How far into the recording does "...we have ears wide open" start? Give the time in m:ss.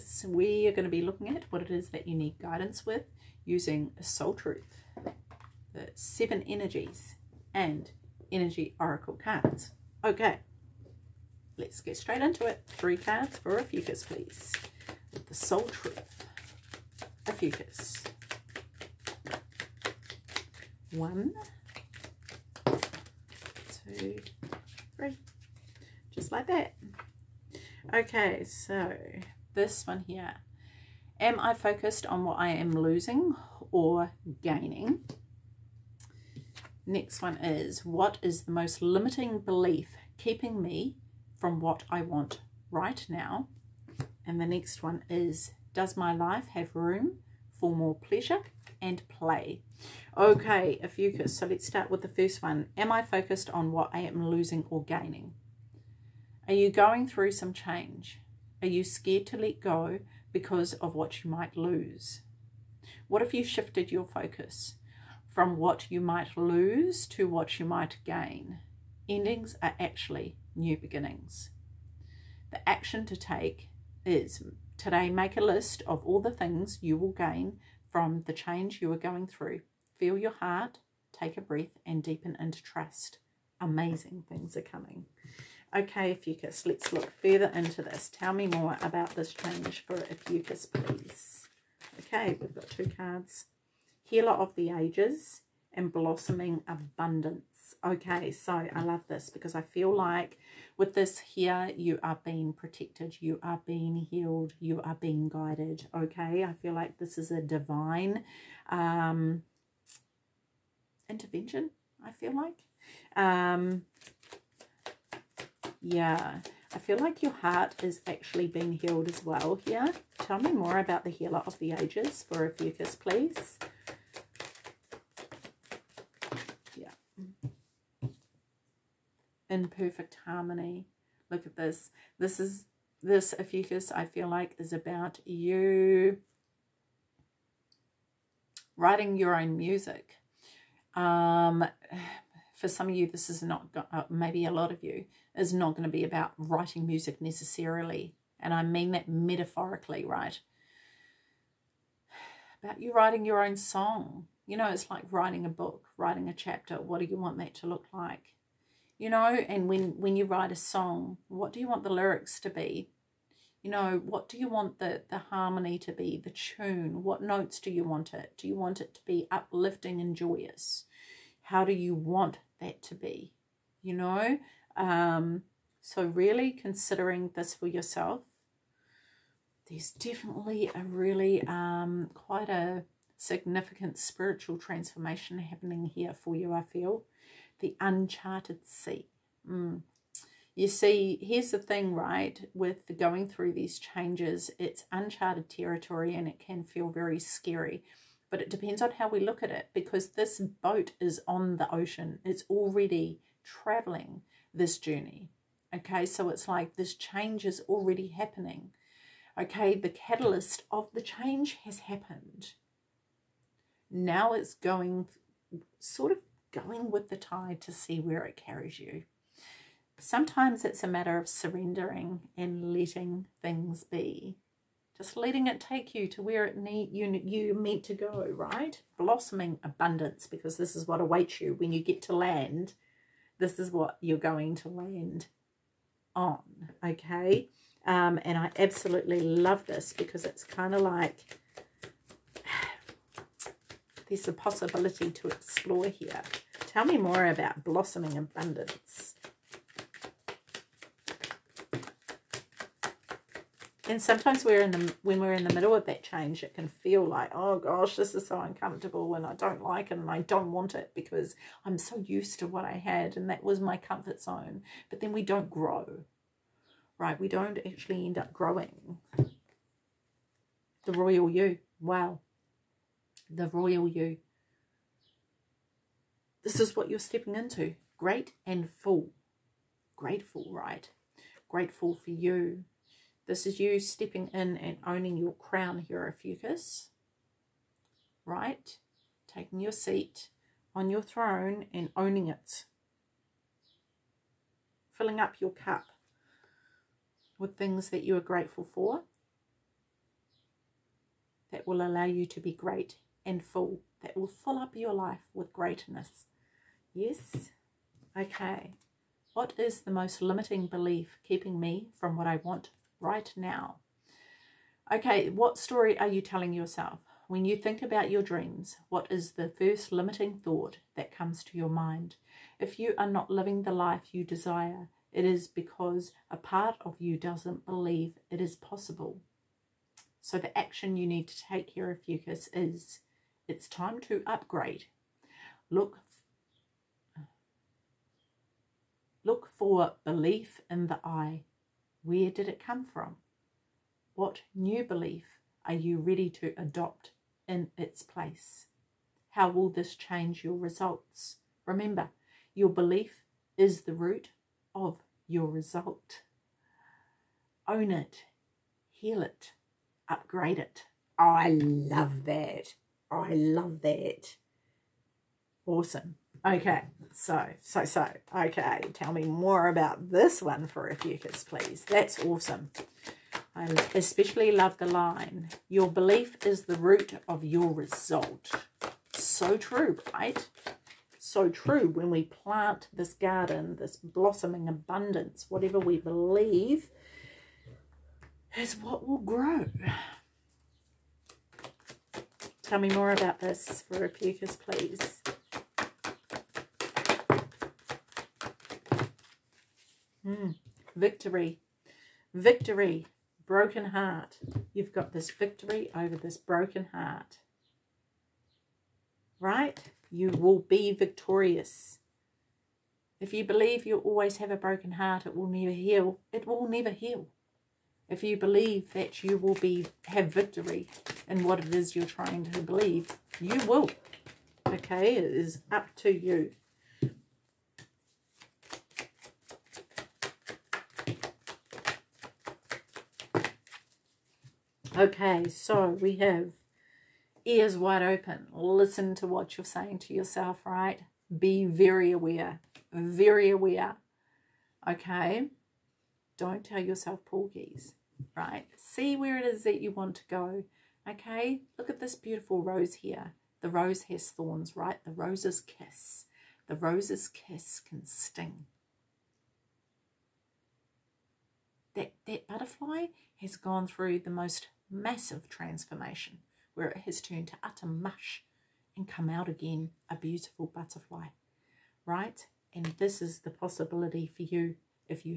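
7:15.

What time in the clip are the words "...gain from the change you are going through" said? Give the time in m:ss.
1:17.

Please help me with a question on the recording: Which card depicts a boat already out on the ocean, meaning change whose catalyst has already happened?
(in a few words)
The uncharted sea.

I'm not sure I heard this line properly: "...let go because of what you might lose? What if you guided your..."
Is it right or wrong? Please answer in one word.
wrong.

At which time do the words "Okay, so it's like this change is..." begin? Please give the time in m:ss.
3:25.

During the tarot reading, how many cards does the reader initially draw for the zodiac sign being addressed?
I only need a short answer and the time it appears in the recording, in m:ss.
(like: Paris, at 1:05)
3, at 0:12.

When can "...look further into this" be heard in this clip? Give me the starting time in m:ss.
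1:26.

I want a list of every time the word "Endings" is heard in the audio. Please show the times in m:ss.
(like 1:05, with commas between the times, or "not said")
1:09.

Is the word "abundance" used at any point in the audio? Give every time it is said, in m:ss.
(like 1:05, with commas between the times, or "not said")
1:36, 3:49, 4:08, 6:24.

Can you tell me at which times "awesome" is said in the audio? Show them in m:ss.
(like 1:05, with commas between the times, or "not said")
6:05, 6:12.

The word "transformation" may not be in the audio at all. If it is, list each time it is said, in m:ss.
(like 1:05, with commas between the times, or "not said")
3:04, 7:45.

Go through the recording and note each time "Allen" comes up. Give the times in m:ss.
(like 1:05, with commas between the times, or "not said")
not said.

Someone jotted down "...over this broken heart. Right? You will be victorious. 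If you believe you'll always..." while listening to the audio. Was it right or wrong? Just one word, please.
right.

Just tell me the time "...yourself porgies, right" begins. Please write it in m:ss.
7:26.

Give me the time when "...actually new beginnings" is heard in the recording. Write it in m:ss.
1:09.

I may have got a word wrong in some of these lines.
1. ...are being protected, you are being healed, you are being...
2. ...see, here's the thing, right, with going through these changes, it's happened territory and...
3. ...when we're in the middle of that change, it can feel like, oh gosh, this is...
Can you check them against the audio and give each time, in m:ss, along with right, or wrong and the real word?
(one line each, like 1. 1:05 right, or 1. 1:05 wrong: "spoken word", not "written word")
1. 1:42 right
2. 3:10 wrong: "uncharted", not "happened"
3. 4:15 right.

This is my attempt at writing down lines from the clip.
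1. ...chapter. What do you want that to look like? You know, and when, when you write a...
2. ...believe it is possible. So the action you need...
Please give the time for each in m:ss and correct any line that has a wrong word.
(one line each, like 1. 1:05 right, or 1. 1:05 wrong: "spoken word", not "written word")
1. 2:36 right
2. 5:27 right.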